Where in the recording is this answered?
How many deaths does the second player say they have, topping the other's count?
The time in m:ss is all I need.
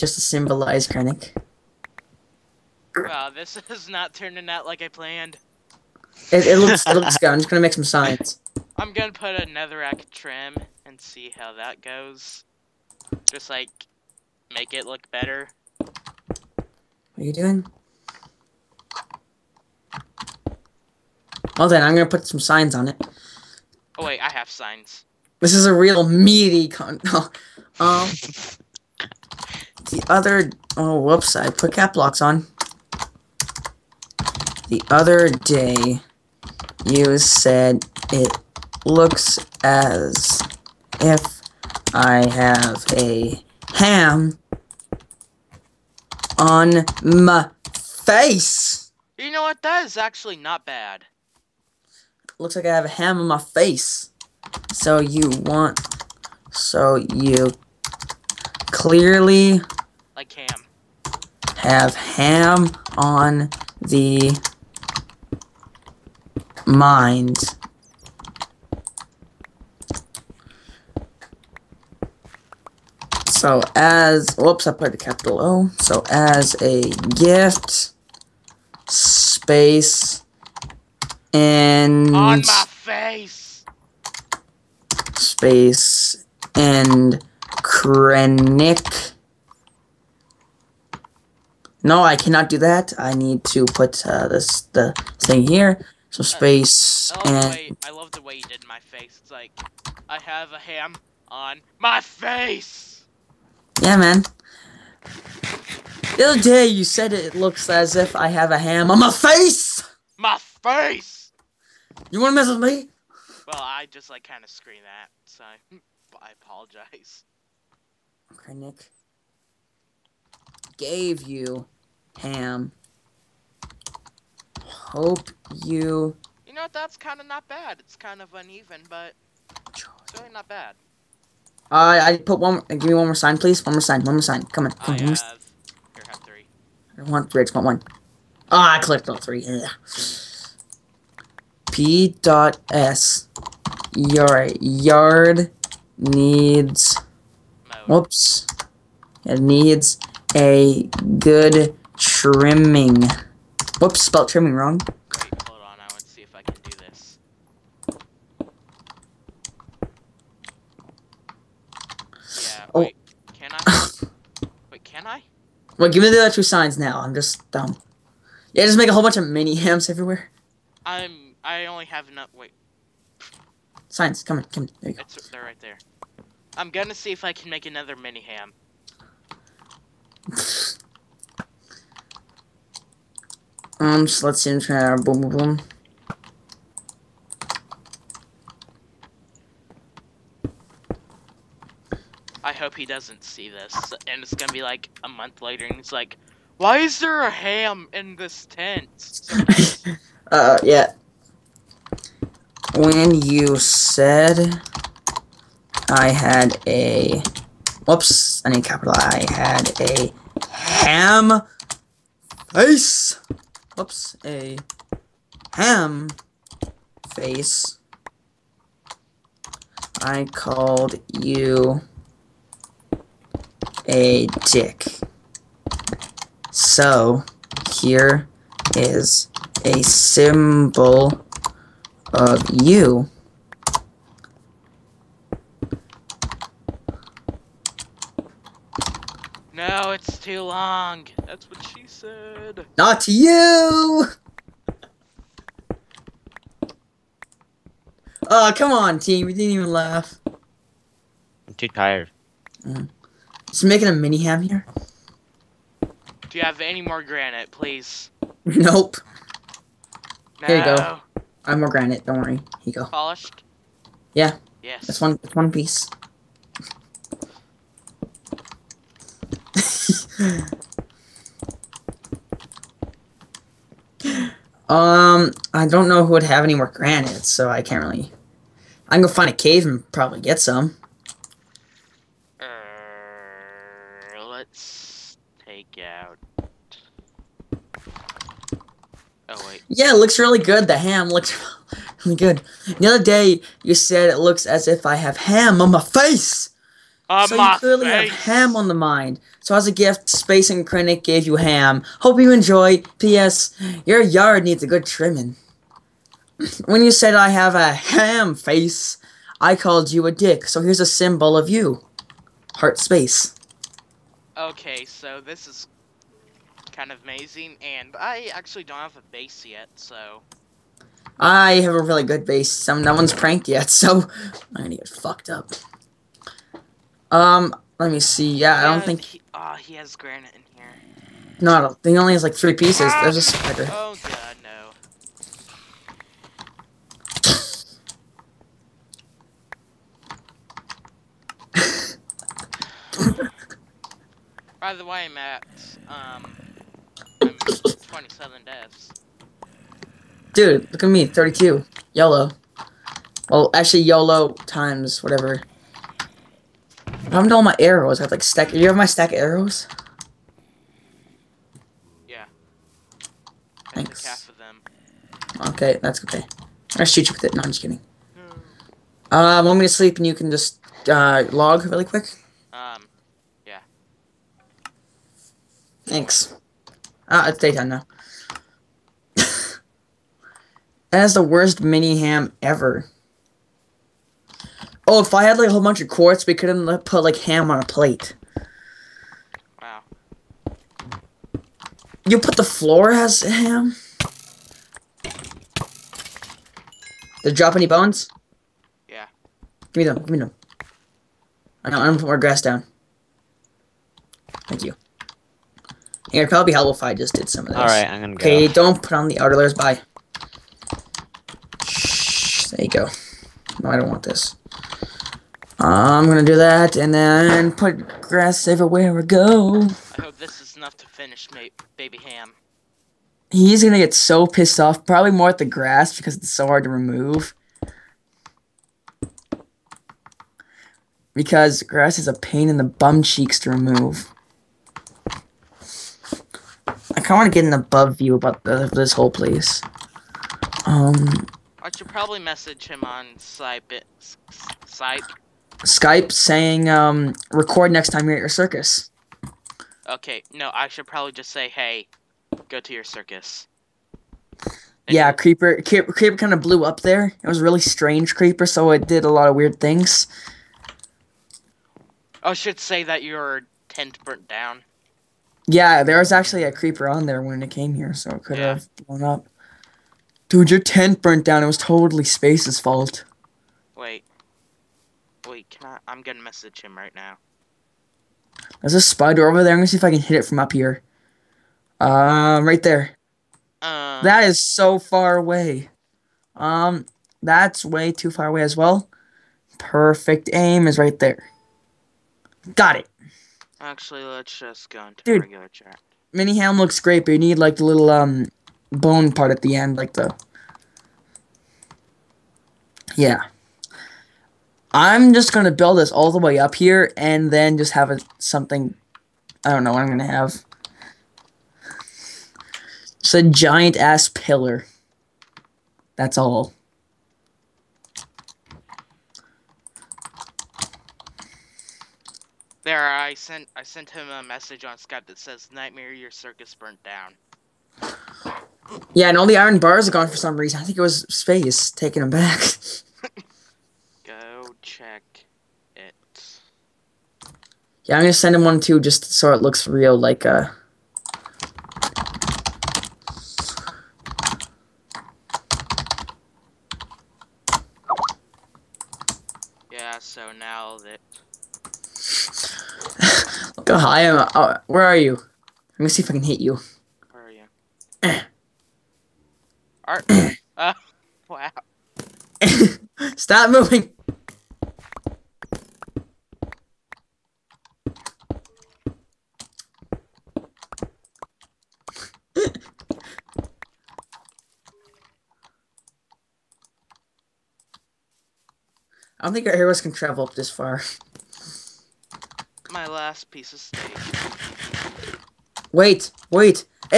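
5:51.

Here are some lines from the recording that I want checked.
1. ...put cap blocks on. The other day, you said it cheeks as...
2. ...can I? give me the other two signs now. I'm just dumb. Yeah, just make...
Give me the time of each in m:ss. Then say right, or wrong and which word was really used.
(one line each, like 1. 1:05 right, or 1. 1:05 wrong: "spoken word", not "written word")
1. 0:31 wrong: "looks", not "cheeks"
2. 2:44 right.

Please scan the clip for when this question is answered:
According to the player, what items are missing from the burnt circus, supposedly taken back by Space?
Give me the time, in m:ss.
8:49.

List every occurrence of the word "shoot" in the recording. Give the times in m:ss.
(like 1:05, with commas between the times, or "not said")
6:06.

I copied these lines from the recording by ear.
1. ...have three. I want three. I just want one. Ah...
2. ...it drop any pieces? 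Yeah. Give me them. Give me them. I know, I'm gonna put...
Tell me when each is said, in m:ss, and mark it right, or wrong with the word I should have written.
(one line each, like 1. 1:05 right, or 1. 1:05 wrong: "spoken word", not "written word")
1. 2:16 right
2. 6:37 wrong: "bones", not "pieces".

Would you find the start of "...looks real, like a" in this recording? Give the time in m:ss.
8:59.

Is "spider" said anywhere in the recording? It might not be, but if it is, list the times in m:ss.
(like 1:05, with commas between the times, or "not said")
5:33, 7:58.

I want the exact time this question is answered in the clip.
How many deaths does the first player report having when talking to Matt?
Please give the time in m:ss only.
5:47.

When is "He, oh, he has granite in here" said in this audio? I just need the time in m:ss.
5:29.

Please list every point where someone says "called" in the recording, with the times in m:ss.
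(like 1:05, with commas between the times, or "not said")
3:40, 5:09.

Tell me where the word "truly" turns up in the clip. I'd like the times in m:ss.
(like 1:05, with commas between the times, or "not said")
not said.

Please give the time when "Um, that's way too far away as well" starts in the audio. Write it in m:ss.
8:06.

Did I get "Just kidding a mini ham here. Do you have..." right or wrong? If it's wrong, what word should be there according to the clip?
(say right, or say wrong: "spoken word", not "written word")
wrong: "making", not "kidding".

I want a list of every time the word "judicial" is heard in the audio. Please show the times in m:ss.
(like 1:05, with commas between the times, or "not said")
not said.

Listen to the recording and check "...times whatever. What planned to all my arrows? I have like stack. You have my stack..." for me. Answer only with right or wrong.
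wrong.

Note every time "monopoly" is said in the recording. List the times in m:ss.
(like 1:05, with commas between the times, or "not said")
not said.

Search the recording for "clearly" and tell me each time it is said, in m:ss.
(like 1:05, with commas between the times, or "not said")
0:58, 4:57.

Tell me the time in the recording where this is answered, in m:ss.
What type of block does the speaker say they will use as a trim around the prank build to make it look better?
0:09.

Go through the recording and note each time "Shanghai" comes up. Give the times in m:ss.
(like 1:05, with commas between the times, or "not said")
not said.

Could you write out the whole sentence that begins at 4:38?
I can go find a cave and probably get some.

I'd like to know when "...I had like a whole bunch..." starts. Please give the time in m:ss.
6:25.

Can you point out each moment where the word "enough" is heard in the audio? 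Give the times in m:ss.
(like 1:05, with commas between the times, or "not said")
2:52, 7:00.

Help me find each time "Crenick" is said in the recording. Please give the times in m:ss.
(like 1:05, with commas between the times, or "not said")
0:00, 1:27, 5:00.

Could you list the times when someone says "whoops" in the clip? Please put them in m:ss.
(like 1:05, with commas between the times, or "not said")
0:31, 1:14, 2:27, 2:33, 3:27, 3:33.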